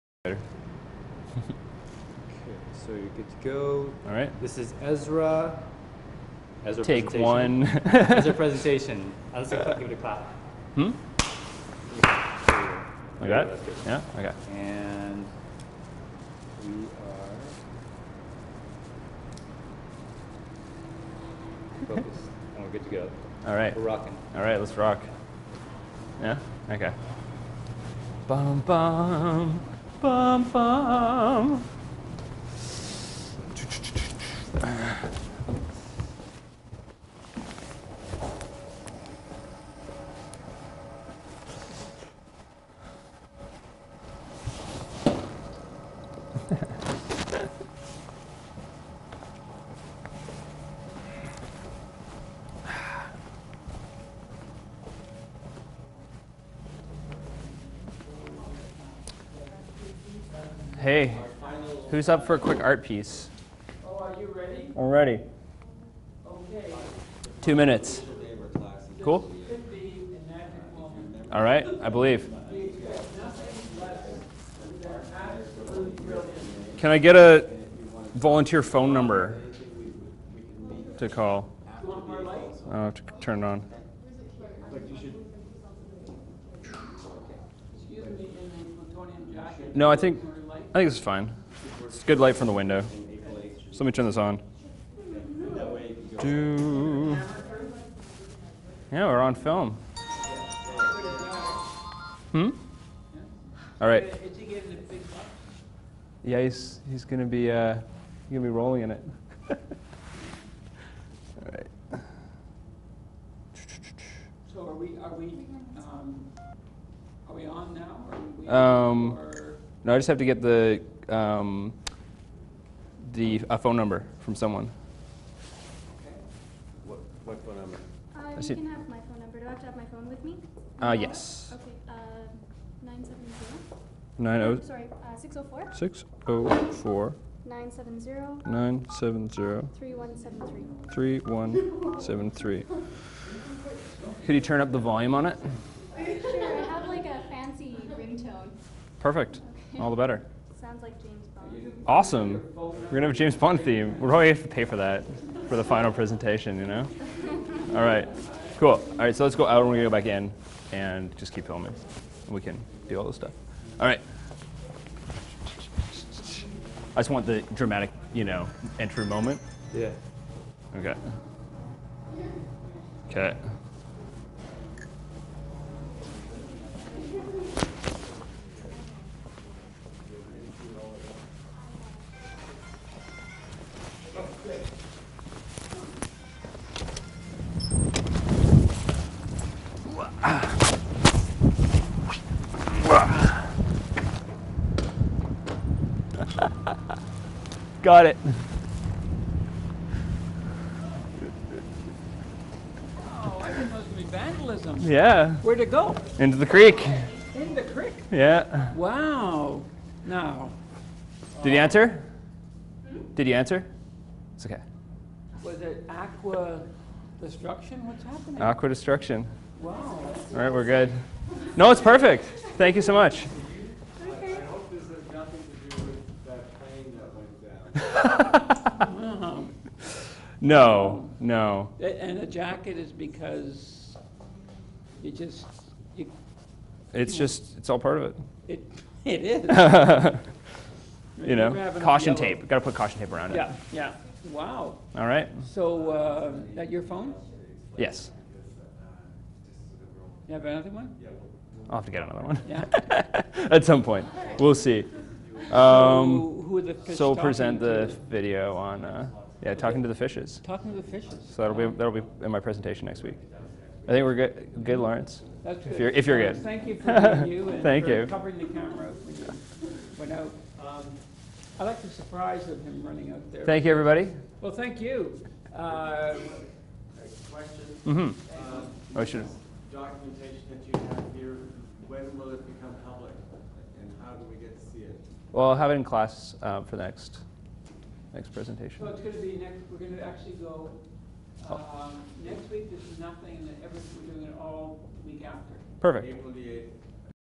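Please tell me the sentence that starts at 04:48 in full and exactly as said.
So it's going to be next.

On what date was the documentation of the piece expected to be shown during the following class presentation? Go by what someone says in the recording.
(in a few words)
April 8.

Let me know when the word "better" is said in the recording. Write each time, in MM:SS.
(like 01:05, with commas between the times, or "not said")
02:29.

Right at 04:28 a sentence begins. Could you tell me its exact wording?
covering the camera for you But no, Um, I like the surprise of him running out there.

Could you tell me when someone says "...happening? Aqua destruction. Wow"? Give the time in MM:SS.
03:38.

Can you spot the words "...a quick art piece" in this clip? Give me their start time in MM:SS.
01:02.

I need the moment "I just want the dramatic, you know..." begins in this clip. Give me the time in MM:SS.
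02:46.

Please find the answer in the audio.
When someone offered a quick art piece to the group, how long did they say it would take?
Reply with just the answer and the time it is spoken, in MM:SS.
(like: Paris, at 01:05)
2 minutes, at 01:07.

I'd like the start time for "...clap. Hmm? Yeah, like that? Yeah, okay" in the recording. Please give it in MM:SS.
00:09.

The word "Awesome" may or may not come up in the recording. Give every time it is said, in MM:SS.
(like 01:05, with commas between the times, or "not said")
02:31.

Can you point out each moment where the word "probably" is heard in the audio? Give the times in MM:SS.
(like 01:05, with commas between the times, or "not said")
02:34.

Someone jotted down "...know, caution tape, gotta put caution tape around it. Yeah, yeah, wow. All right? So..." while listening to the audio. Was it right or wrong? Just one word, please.
right.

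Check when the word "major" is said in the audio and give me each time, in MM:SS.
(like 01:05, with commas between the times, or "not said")
not said.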